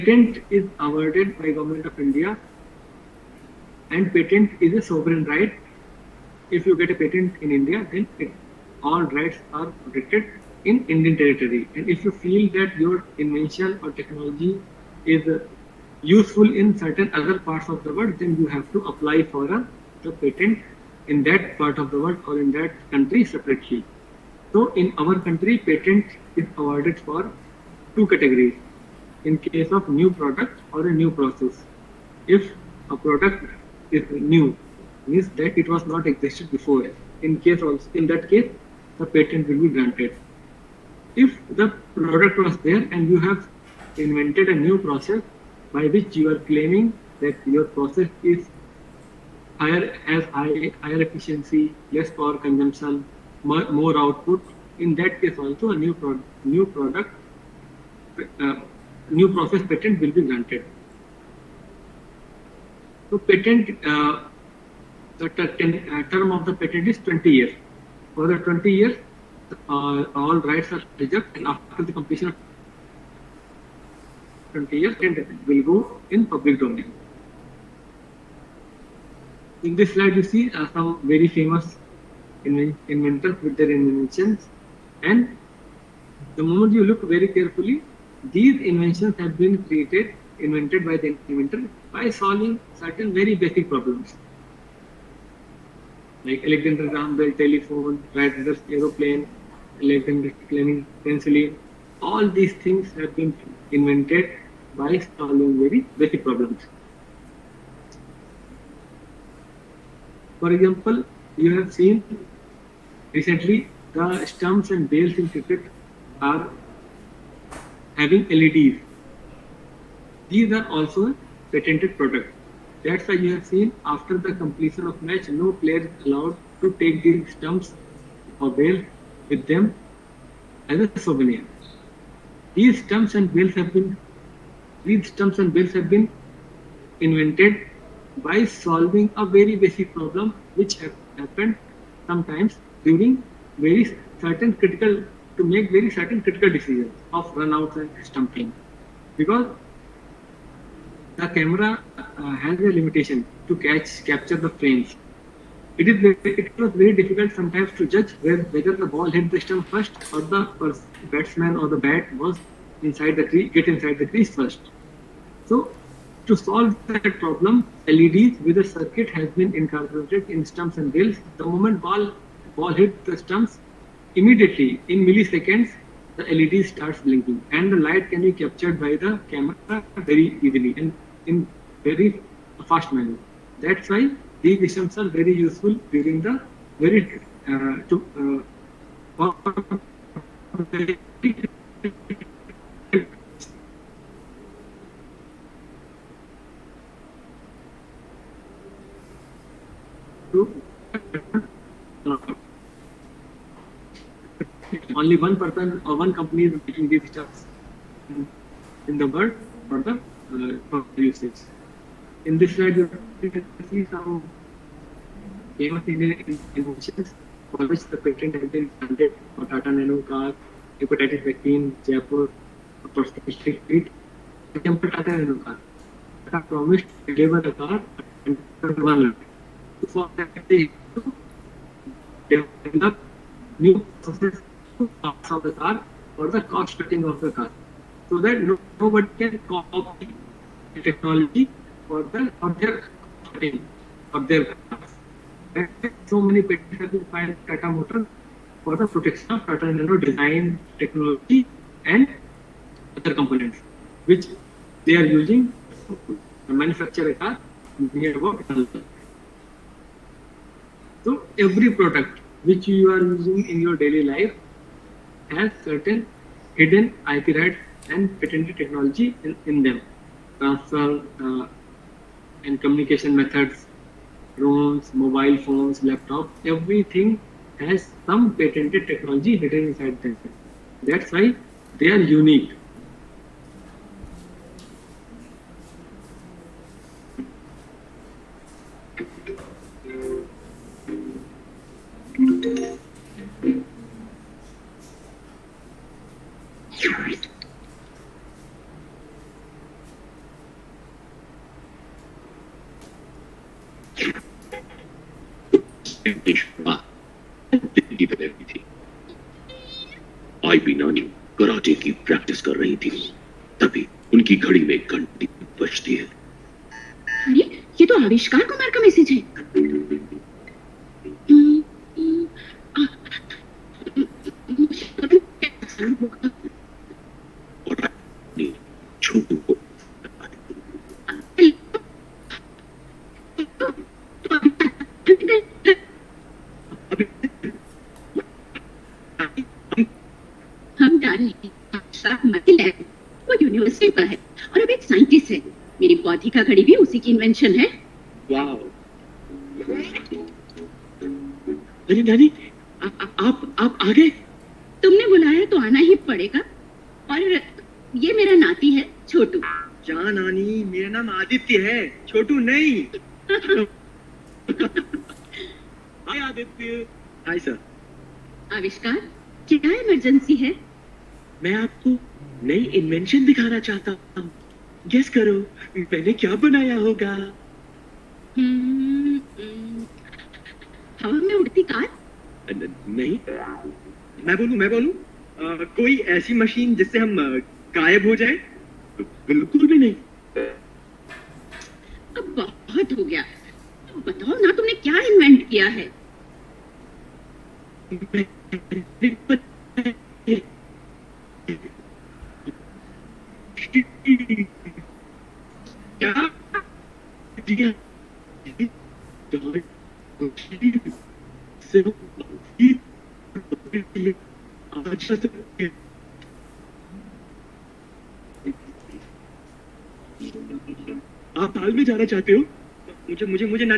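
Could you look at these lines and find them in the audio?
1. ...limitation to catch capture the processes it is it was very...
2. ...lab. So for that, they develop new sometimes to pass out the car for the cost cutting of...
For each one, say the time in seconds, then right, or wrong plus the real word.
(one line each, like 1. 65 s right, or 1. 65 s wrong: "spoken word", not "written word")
1. 152 s wrong: "frames", not "processes"
2. 229 s wrong: "processes", not "sometimes".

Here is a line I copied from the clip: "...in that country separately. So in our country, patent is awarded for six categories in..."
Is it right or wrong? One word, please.
wrong.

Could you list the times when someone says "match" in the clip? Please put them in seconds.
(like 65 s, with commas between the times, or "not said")
125 s.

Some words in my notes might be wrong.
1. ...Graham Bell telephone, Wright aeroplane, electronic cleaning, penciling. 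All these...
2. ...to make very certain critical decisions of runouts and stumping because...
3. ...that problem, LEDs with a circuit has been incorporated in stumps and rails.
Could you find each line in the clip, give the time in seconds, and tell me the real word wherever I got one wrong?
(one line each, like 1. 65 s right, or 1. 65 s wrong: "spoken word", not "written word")
1. 96 s right
2. 145 s right
3. 166 s right.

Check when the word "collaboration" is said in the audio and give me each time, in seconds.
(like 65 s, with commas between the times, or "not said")
not said.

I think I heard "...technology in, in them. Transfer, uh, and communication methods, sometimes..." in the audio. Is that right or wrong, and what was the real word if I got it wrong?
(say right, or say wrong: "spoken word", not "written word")
wrong: "drones", not "sometimes".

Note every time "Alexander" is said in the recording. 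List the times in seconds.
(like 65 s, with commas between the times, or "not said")
96 s.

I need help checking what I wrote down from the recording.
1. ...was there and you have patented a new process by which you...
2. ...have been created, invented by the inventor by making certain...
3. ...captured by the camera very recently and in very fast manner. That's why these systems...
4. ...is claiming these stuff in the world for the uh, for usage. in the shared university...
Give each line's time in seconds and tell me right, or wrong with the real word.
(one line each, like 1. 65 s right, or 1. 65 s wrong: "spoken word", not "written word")
1. 42 s wrong: "invented", not "patented"
2. 89 s wrong: "solving", not "making"
3. 178 s wrong: "easily", not "recently"
4. 206 s wrong: "making", not "claiming".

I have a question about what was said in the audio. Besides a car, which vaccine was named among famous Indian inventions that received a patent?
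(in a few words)
Hepatitis vaccine.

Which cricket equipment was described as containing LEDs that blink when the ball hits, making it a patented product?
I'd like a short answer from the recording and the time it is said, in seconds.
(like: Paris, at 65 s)
Stumps and bails, at 114 s.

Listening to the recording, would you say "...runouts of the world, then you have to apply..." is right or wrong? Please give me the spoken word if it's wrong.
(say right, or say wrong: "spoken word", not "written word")
wrong: "parts", not "runouts".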